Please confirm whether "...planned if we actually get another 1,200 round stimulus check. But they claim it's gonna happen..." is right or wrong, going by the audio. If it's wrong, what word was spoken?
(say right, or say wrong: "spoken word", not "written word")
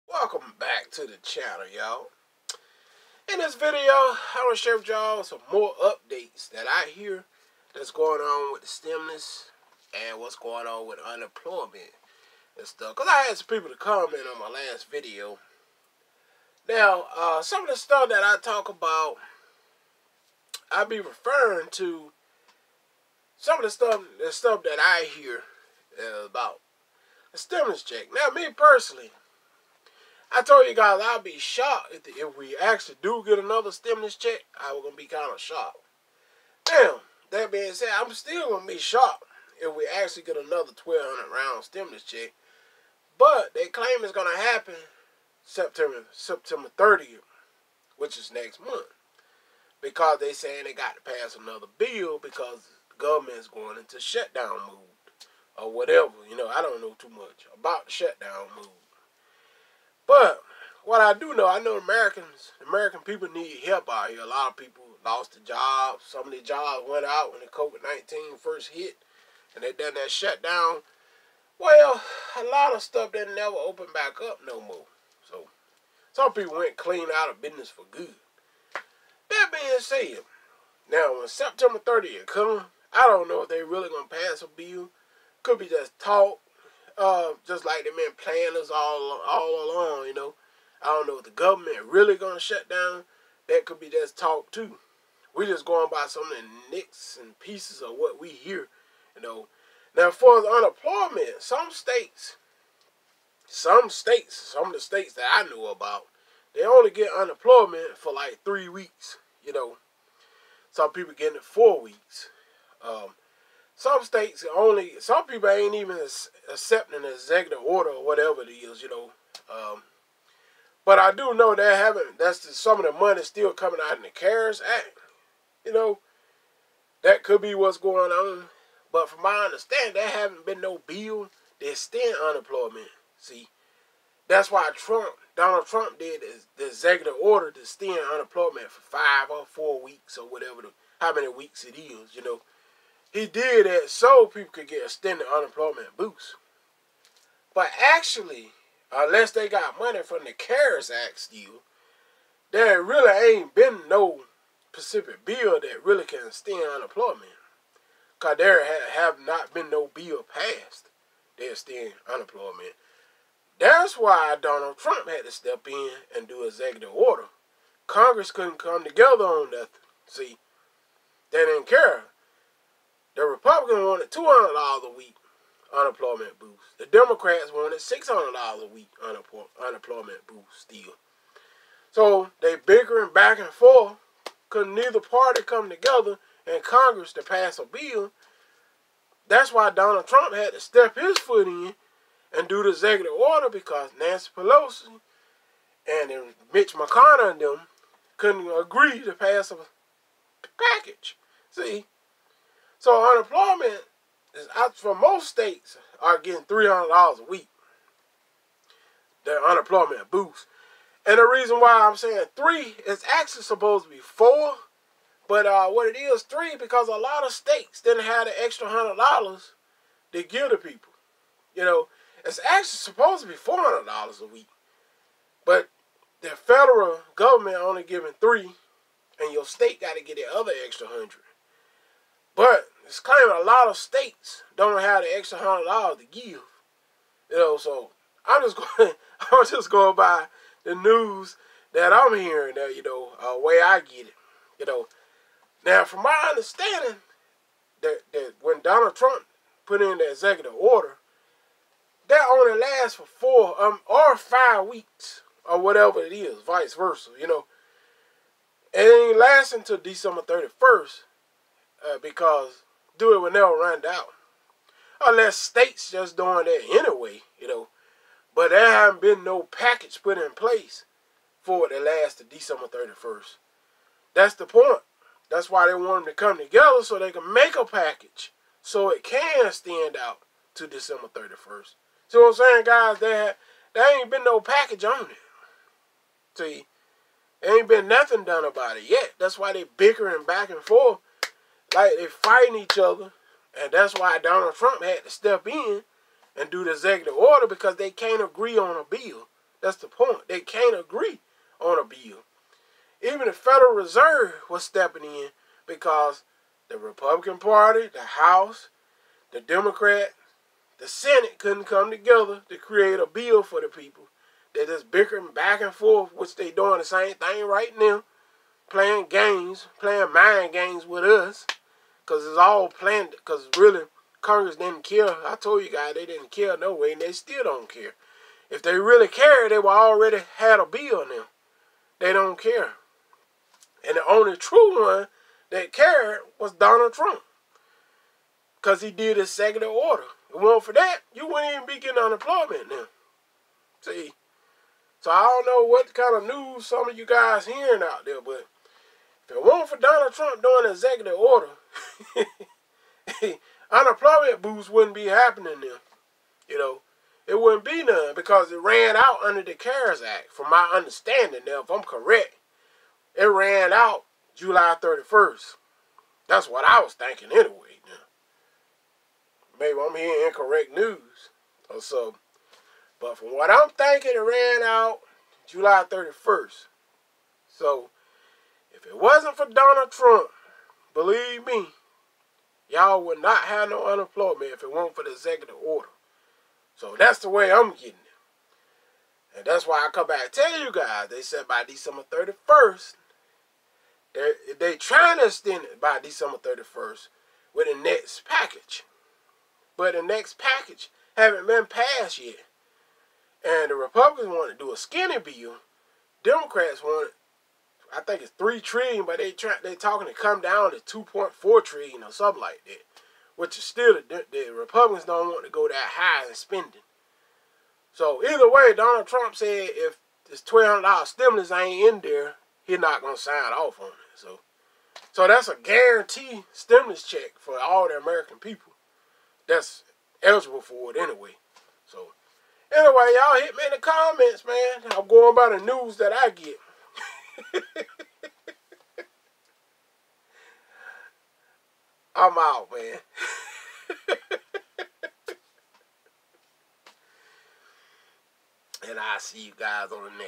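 wrong: "shocked", not "planned".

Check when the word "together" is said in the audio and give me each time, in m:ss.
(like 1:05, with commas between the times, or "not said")
2:48, 3:05, 4:36, 5:11.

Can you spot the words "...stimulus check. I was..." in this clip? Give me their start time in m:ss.
0:33.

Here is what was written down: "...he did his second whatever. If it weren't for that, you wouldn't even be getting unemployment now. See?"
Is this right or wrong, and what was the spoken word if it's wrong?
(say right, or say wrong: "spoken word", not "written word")
wrong: "order", not "whatever".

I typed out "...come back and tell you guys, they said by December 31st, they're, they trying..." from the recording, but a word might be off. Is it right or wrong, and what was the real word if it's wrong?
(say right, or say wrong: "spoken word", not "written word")
right.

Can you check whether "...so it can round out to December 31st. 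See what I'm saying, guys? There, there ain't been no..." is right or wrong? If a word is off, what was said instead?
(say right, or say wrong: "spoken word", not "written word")
wrong: "stand", not "round".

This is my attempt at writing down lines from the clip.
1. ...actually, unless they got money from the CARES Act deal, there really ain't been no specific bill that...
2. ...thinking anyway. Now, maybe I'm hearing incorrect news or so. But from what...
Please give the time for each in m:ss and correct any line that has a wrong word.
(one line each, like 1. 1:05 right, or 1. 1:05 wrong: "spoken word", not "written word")
1. 2:27 right
2. 6:06 right.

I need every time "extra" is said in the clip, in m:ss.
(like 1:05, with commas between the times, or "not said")
3:38, 3:50, 3:55.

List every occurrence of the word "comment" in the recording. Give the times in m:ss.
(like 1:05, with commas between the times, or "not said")
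0:13, 7:13.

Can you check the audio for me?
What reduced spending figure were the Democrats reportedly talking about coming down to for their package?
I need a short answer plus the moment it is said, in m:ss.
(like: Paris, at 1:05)
2.4 trillion, at 6:50.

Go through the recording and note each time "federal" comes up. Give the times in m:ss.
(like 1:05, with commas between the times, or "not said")
3:46, 5:03.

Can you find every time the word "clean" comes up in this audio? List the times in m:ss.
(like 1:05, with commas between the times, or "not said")
1:16.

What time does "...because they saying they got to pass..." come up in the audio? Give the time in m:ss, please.
0:49.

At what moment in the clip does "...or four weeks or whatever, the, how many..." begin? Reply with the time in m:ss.
2:19.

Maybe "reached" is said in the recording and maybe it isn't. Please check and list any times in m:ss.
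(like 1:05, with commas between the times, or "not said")
not said.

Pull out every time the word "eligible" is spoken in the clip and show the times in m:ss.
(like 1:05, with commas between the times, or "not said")
7:10.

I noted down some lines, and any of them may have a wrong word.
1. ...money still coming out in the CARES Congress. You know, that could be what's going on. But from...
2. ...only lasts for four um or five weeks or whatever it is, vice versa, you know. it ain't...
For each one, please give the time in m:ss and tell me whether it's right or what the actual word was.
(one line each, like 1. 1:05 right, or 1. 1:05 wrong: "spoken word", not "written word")
1. 2:02 wrong: "Act", not "Congress"
2. 4:12 right.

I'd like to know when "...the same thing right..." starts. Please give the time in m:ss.
5:16.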